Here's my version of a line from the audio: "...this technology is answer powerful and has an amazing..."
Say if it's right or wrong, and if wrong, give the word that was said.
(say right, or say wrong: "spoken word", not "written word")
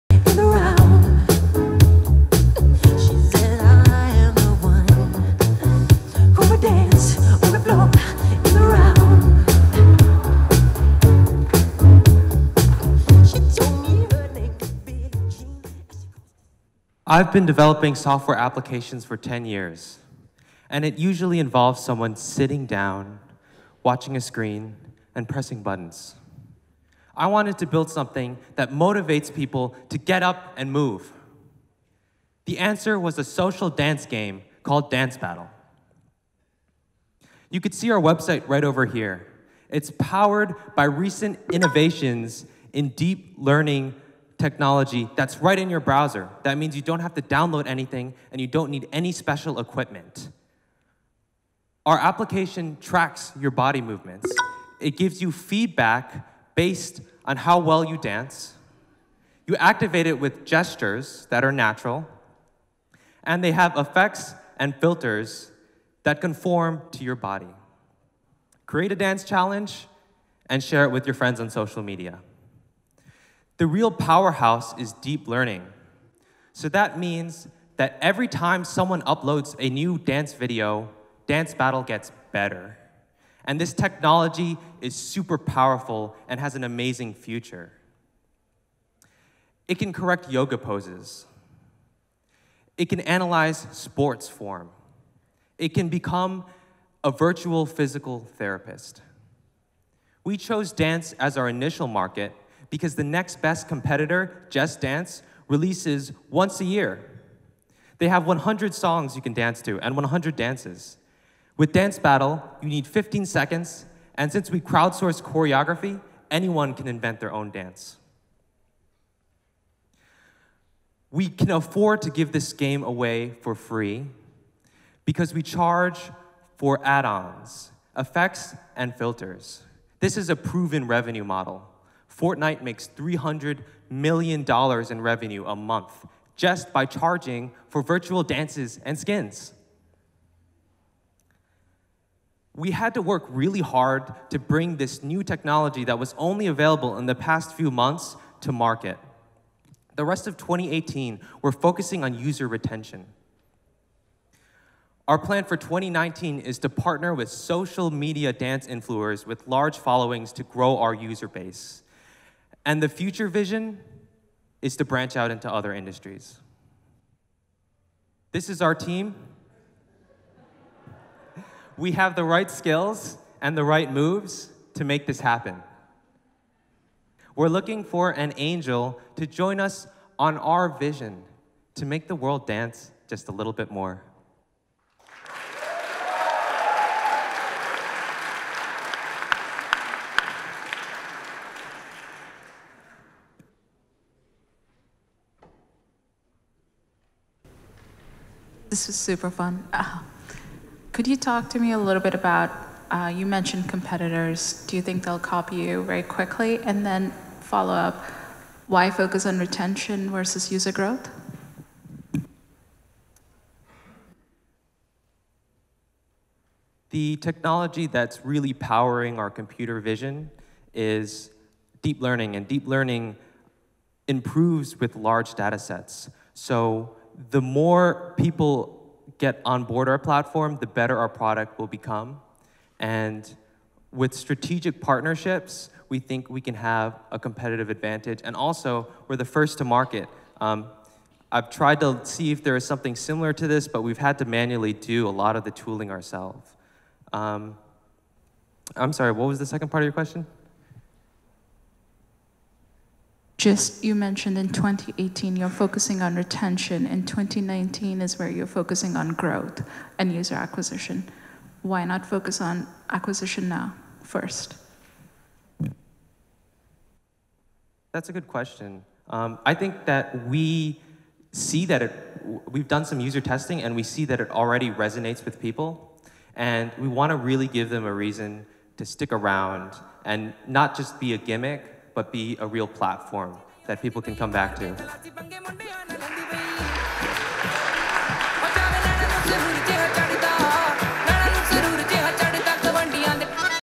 wrong: "super", not "answer".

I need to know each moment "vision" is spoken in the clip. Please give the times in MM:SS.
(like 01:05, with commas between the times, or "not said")
02:43, 03:00, 03:39.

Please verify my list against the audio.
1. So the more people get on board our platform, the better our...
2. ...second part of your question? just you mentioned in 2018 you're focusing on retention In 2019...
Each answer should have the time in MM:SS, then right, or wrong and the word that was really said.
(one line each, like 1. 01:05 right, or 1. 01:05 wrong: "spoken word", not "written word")
1. 03:46 right
2. 04:09 right.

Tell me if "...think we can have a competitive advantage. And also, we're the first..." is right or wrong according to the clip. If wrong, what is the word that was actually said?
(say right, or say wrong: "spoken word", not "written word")
right.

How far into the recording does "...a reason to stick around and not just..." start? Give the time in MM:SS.
04:37.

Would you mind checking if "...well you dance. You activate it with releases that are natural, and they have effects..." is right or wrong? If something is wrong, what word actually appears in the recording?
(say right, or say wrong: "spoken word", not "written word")
wrong: "gestures", not "releases".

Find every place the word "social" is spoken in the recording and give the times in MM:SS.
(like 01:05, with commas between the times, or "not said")
00:33, 01:11, 02:37.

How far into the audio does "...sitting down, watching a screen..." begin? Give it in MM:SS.
00:22.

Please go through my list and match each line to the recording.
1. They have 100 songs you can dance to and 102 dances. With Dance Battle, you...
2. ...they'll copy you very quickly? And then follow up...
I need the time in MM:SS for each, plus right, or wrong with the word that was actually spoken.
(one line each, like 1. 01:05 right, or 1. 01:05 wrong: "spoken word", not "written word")
1. 01:47 wrong: "100", not "102"
2. 03:25 right.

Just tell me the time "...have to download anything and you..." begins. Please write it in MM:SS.
00:46.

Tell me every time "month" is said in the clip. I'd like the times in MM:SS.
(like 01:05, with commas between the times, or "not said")
02:15, 02:27.